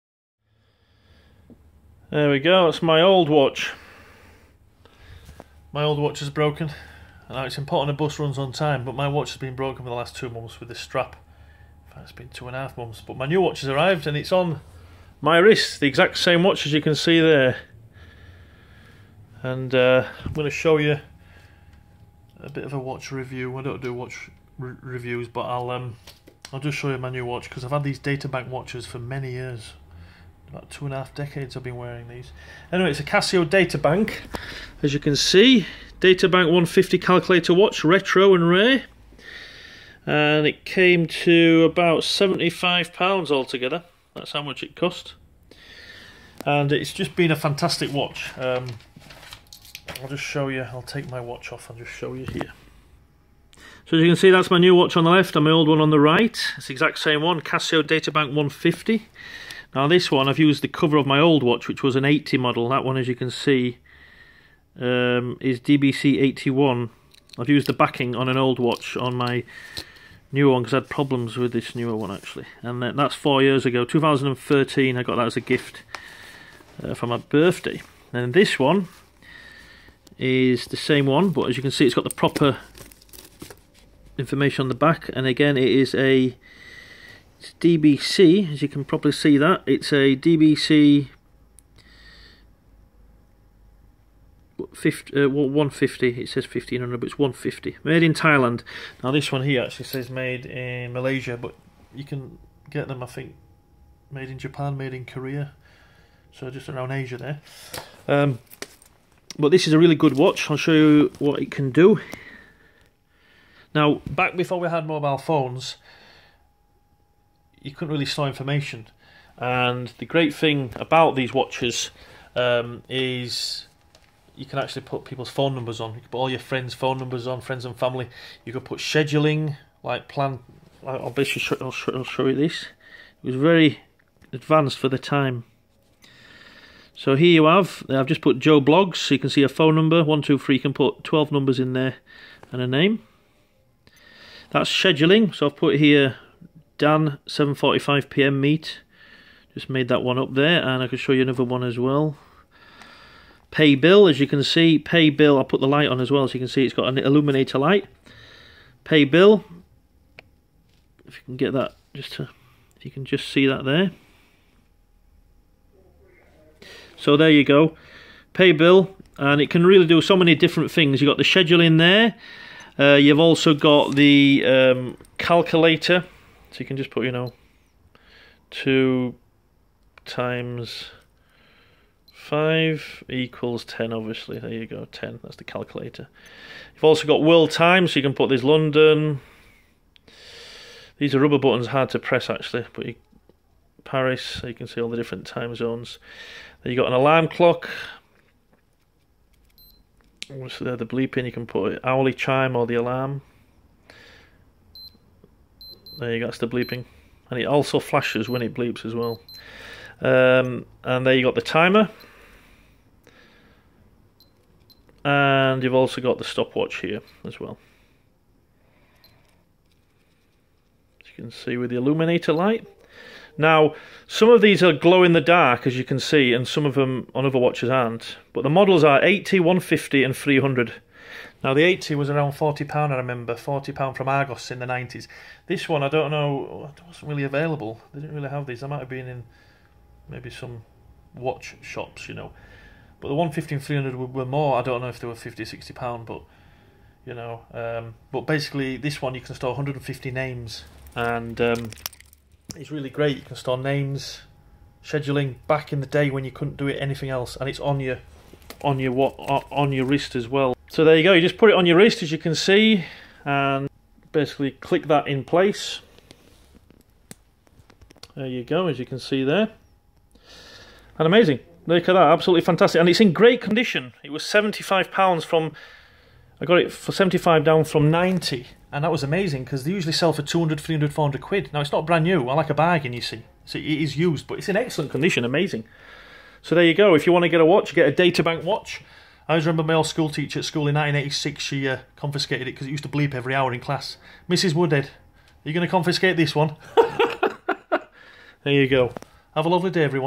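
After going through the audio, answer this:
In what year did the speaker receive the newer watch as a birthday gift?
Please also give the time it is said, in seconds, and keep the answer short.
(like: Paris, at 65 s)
2013, at 73 s.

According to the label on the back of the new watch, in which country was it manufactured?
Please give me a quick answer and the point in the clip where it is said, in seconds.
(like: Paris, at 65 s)
Thailand, at 98 s.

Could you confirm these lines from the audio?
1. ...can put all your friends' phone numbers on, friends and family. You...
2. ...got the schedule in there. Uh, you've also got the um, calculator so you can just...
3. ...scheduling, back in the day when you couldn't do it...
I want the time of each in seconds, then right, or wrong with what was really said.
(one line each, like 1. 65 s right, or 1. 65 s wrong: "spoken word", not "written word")
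1. 126 s right
2. 171 s right
3. 254 s right.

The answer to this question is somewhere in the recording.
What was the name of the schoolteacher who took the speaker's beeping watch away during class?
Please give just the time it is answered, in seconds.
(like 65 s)
294 s.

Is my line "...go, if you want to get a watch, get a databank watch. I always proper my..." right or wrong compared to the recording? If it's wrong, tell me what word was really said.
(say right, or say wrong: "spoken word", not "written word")
wrong: "remember", not "proper".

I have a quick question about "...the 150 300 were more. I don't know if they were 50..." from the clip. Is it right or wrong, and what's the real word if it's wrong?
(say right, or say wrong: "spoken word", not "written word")
right.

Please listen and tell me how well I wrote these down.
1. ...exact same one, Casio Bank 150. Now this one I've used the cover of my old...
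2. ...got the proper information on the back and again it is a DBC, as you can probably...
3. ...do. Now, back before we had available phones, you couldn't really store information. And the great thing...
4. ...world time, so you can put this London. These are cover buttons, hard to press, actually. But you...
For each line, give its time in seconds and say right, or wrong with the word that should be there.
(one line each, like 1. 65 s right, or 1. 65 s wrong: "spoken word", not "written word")
1. 56 s right
2. 81 s right
3. 111 s wrong: "mobile", not "available"
4. 187 s wrong: "rubber", not "cover".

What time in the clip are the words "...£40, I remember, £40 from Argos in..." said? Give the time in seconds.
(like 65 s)
232 s.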